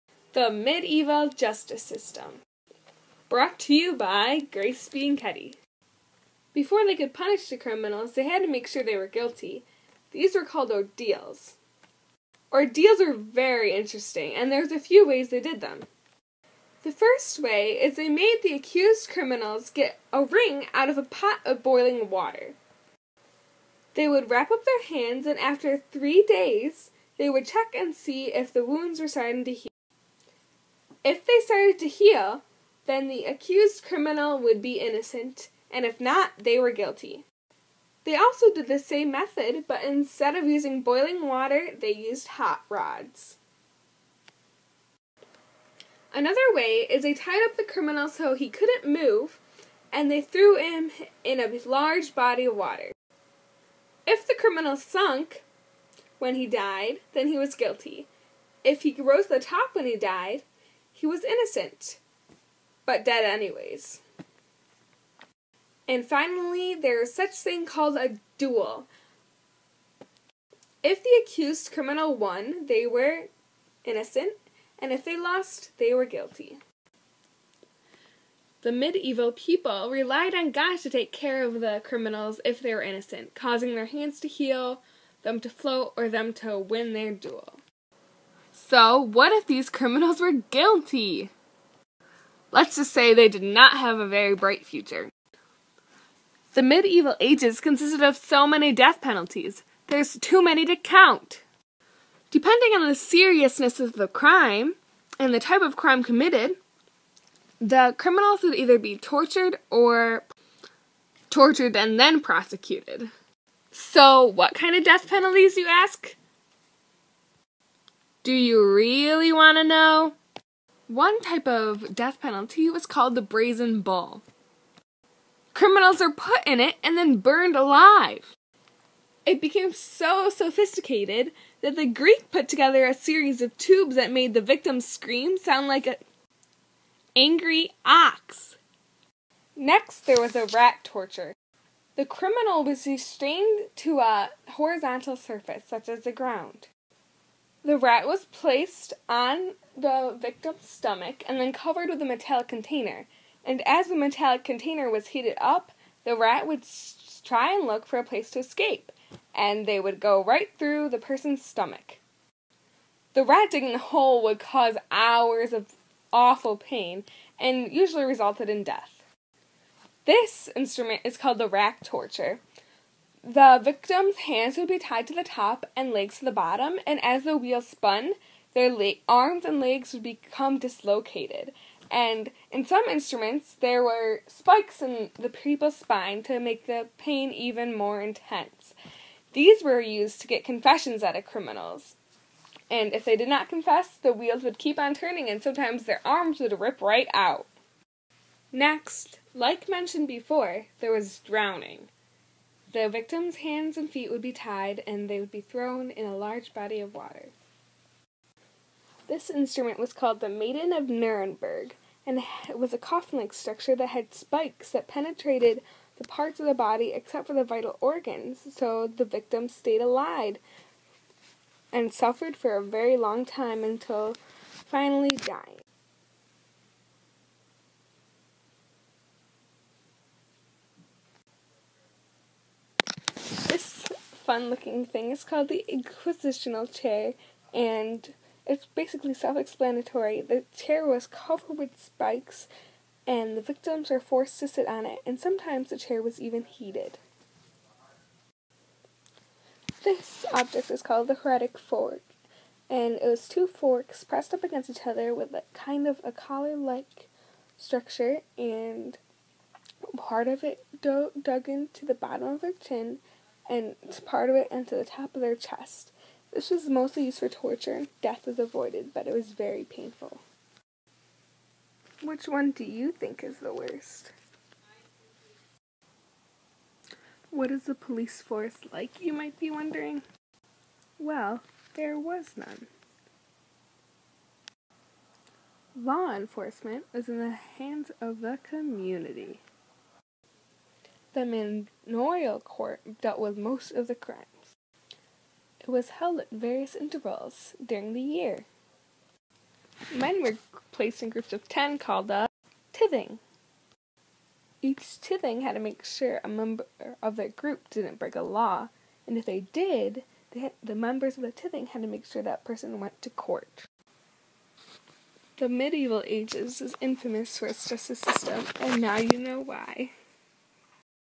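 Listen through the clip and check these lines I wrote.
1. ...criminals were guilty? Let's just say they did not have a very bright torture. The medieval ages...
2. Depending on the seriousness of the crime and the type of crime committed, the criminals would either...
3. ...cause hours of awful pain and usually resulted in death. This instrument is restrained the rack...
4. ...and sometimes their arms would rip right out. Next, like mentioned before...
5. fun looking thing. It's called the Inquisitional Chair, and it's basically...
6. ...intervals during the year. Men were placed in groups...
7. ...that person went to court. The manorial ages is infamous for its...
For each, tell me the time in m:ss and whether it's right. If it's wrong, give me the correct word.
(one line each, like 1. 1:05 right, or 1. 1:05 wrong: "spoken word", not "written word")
1. 1:29 wrong: "future", not "torture"
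2. 1:42 right
3. 2:44 wrong: "called", not "restrained"
4. 3:15 right
5. 3:54 right
6. 4:56 right
7. 5:12 wrong: "medieval", not "manorial".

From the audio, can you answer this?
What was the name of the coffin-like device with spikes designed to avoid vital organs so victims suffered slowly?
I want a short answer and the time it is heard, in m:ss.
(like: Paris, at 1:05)
Maiden of Nuremberg, at 3:30.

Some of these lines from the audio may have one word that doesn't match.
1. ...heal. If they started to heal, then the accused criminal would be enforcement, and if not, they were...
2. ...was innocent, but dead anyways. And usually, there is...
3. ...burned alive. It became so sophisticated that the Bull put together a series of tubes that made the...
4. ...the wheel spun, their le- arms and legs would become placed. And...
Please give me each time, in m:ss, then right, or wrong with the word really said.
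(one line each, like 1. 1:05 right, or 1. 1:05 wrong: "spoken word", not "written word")
1. 0:29 wrong: "innocent", not "enforcement"
2. 1:01 wrong: "finally", not "usually"
3. 2:07 wrong: "Greek", not "Bull"
4. 2:57 wrong: "dislocated", not "placed".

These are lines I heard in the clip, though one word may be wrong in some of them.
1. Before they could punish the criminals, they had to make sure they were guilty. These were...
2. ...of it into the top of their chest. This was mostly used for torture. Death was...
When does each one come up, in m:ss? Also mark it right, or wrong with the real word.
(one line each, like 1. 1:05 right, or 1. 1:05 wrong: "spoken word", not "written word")
1. 0:06 right
2. 4:24 right.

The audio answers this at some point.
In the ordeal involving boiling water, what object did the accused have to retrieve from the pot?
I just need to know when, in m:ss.
0:20.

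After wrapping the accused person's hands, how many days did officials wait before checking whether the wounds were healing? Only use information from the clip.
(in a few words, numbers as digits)
3.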